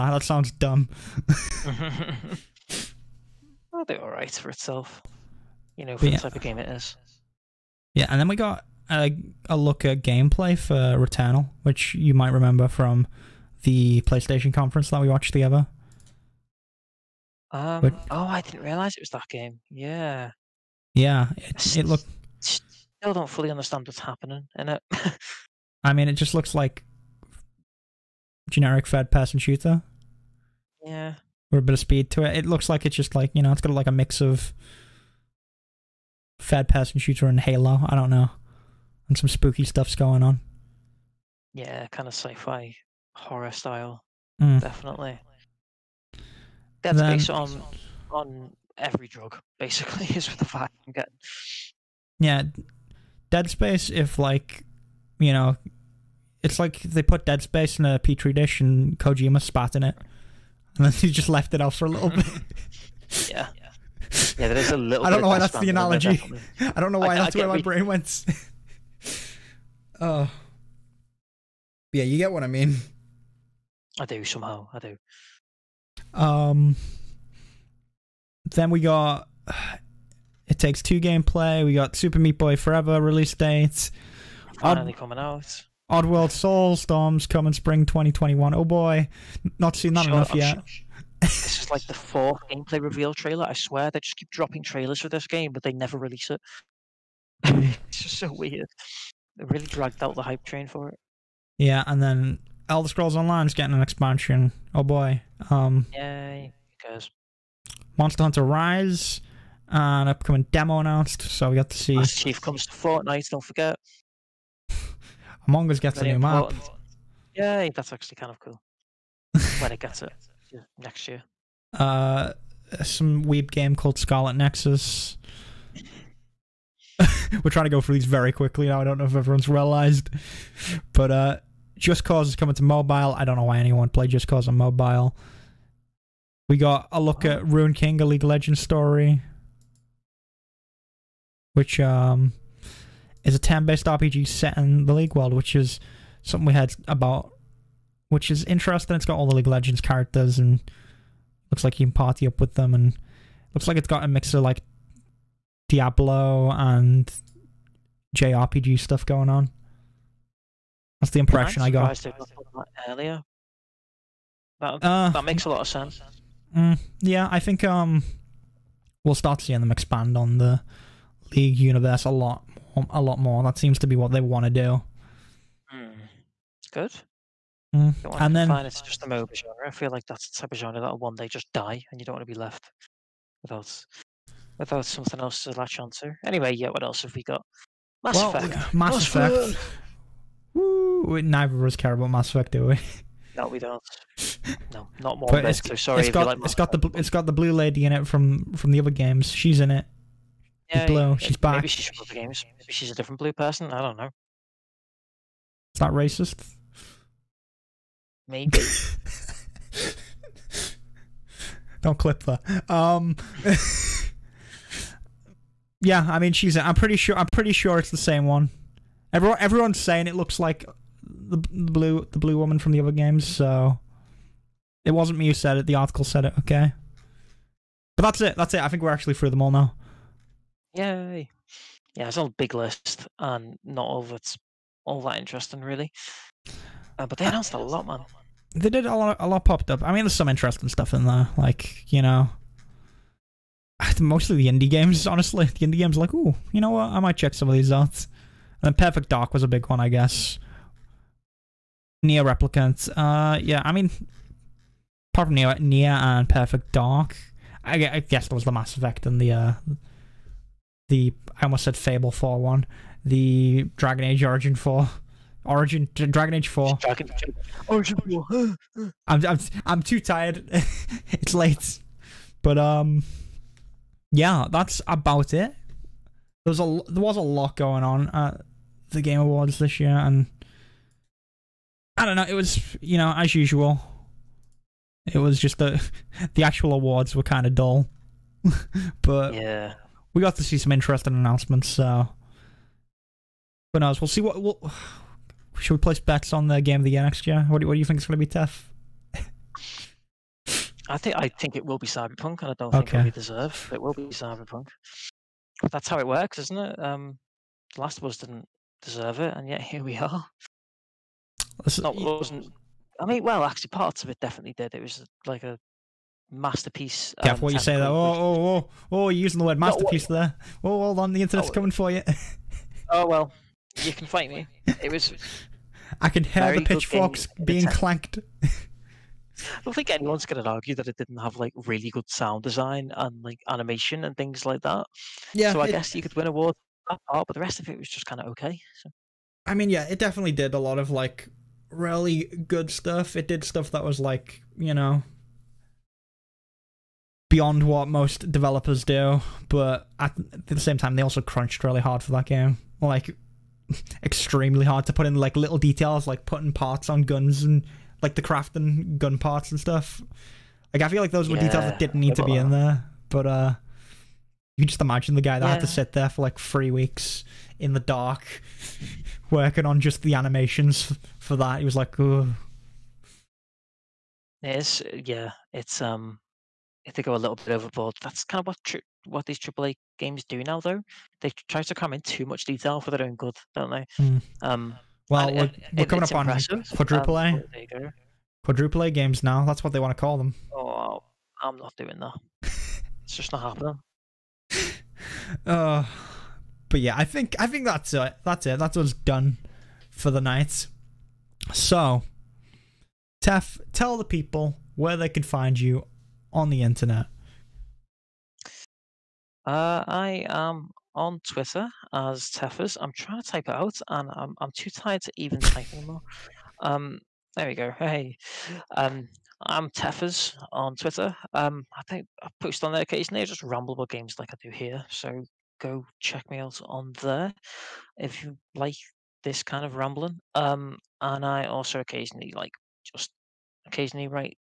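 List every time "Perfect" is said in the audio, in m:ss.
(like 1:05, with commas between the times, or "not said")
4:08, 4:16.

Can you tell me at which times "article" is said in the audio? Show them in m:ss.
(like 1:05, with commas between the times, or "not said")
3:45.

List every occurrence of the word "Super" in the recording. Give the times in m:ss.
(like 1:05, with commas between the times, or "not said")
1:21.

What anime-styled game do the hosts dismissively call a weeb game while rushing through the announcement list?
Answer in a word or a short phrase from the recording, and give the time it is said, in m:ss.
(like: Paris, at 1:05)
Scarlet Nexus, at 2:03.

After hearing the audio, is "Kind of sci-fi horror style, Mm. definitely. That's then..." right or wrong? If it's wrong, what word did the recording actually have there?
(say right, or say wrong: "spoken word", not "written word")
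right.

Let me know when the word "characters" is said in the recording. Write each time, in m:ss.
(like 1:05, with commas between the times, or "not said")
2:29.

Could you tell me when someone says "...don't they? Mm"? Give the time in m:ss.
6:23.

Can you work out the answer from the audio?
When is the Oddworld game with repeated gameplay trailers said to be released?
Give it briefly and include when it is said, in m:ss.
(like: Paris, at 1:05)
spring 2021, at 1:27.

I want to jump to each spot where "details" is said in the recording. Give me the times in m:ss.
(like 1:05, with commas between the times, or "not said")
5:55, 6:01, 6:22.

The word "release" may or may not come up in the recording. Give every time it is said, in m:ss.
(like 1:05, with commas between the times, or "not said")
1:22, 1:35.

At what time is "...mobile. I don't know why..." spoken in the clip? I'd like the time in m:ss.
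2:12.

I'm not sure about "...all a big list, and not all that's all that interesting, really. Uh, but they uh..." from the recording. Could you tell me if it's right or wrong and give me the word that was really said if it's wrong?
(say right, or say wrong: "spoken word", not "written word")
right.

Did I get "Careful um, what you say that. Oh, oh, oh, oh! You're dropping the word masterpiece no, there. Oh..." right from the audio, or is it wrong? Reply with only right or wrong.
wrong.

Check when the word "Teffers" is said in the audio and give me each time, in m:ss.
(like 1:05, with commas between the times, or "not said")
6:52, 6:59.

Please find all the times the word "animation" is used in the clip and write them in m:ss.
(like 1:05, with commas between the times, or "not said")
5:33, 6:10.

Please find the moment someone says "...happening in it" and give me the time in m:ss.
0:23.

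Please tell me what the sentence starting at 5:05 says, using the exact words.
That's how it works, isn't it?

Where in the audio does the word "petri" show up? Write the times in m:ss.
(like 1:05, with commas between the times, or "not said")
0:57.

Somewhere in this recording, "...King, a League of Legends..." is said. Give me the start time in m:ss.
2:17.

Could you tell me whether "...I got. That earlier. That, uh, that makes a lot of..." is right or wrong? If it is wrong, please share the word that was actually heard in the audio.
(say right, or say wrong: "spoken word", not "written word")
right.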